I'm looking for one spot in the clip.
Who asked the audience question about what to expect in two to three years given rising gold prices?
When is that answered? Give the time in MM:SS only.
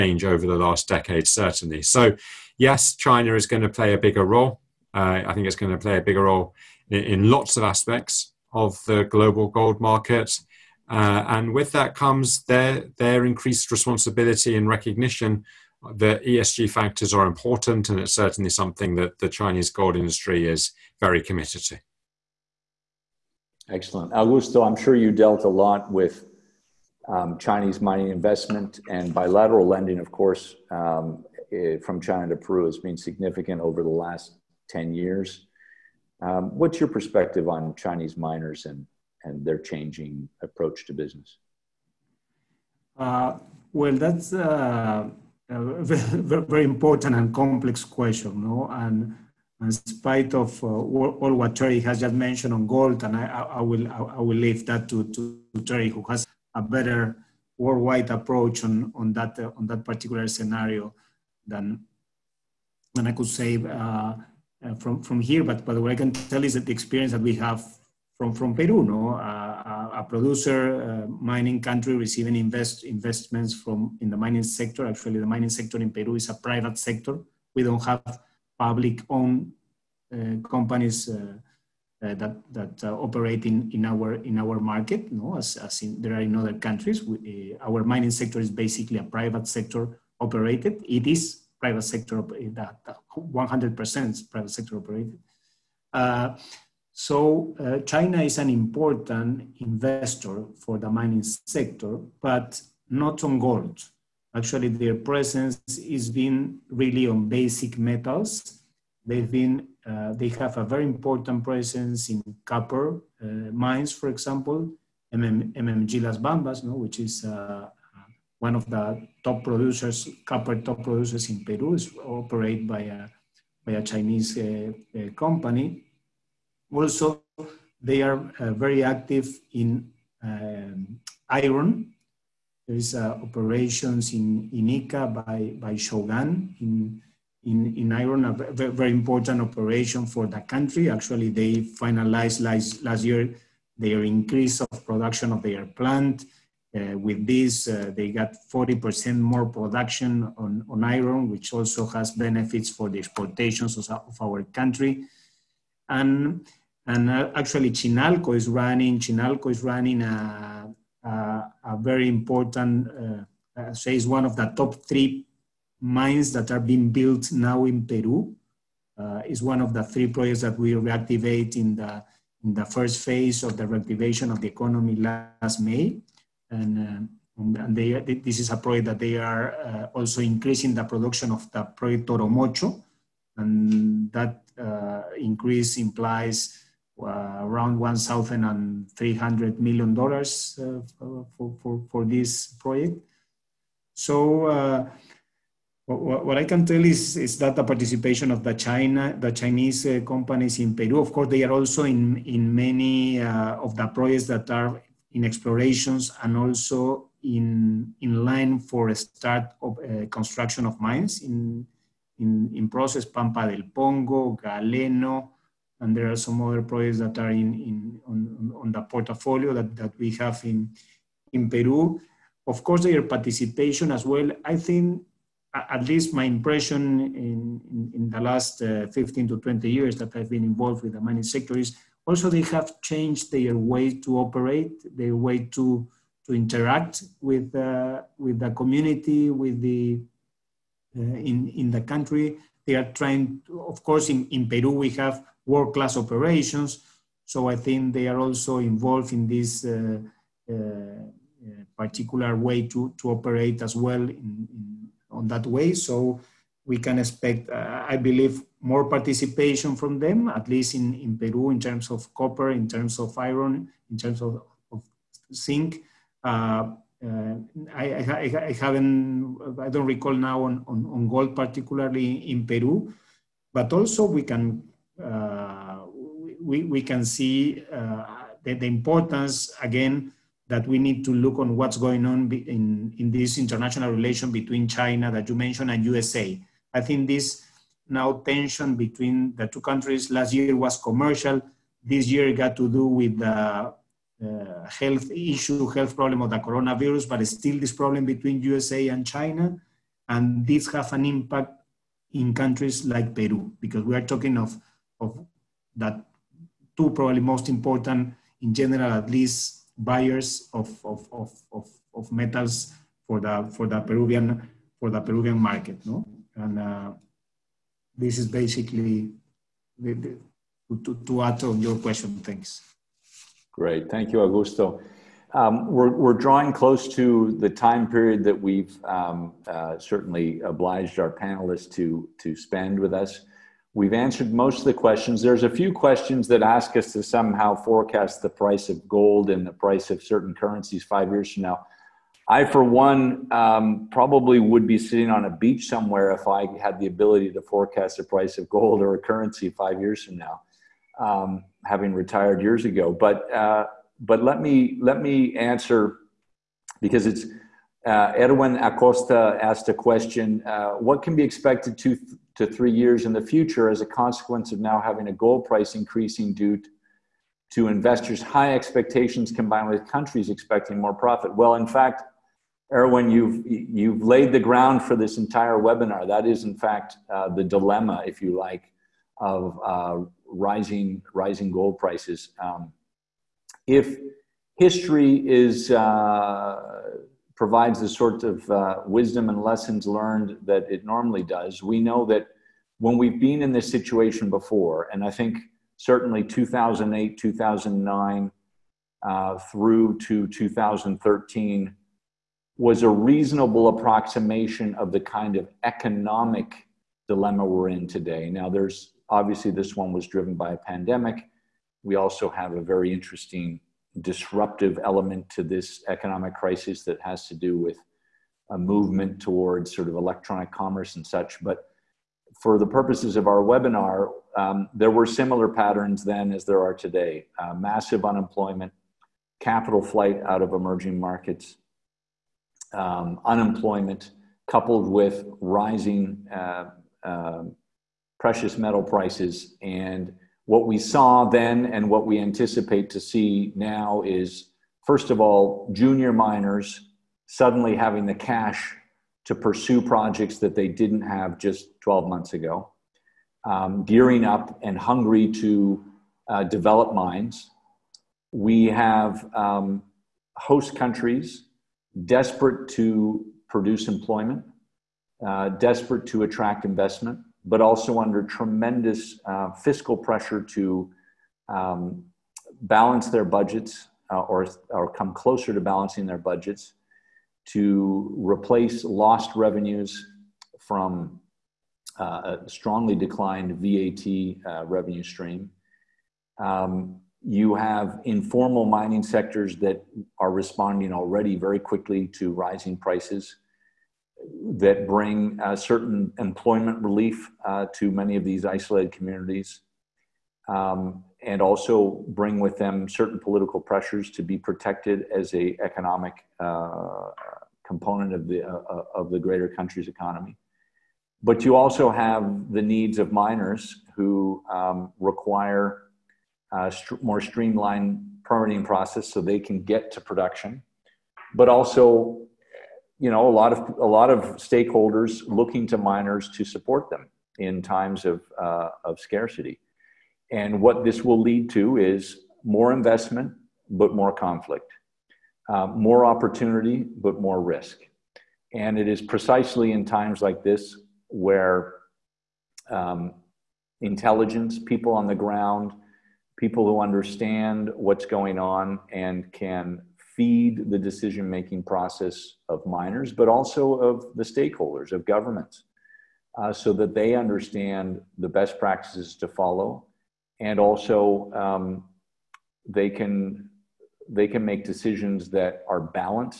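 05:58.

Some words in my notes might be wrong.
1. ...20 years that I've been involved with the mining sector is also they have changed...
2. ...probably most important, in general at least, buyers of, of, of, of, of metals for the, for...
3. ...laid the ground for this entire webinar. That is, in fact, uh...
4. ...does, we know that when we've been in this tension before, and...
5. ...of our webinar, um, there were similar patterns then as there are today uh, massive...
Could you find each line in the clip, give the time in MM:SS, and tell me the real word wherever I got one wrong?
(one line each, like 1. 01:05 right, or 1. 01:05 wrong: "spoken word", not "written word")
1. 03:49 right
2. 05:06 right
3. 06:14 right
4. 06:31 wrong: "situation", not "tension"
5. 07:03 right.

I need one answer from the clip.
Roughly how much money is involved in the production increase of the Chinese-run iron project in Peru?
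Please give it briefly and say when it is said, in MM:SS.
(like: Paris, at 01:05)
$1,300 million, at 03:07.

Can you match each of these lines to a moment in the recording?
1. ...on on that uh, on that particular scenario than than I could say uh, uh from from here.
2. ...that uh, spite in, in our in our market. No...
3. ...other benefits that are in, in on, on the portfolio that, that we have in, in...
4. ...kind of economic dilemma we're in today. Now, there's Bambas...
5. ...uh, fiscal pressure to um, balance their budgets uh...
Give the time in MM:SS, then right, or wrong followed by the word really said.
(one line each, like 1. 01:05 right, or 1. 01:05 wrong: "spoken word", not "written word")
1. 00:58 right
2. 01:22 wrong: "operate", not "spite"
3. 03:36 wrong: "projects", not "benefits"
4. 06:45 wrong: "Obviously", not "Bambas"
5. 07:49 right.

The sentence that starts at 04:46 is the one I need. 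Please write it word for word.
I think this now tension between the two countries last year was commercial.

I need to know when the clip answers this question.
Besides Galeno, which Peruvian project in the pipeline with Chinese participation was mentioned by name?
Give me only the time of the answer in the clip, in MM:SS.
03:33.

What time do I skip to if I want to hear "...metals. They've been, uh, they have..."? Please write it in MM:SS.
01:47.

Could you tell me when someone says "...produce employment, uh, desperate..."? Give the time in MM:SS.
07:43.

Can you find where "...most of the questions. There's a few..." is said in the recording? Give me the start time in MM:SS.
05:34.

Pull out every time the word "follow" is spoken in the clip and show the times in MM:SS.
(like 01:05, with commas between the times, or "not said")
09:19.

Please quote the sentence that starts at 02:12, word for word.
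There is uh, operations in, in Ica by, by Shougang in, in, in iron, a very, important operation for the country.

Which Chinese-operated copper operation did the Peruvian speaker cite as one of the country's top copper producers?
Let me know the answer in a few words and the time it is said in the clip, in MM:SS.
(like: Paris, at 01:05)
MMG Las Bambas, at 01:55.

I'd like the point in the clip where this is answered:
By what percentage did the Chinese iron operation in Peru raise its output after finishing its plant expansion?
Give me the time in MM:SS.
02:28.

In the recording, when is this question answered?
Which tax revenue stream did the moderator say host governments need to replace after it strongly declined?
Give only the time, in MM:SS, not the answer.
08:03.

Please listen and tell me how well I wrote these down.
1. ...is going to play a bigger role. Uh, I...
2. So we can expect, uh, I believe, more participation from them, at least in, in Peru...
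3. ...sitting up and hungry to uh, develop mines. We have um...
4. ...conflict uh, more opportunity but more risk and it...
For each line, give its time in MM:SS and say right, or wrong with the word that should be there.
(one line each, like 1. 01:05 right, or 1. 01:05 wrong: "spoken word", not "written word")
1. 00:03 right
2. 04:15 right
3. 07:33 wrong: "gearing", not "sitting"
4. 08:54 right.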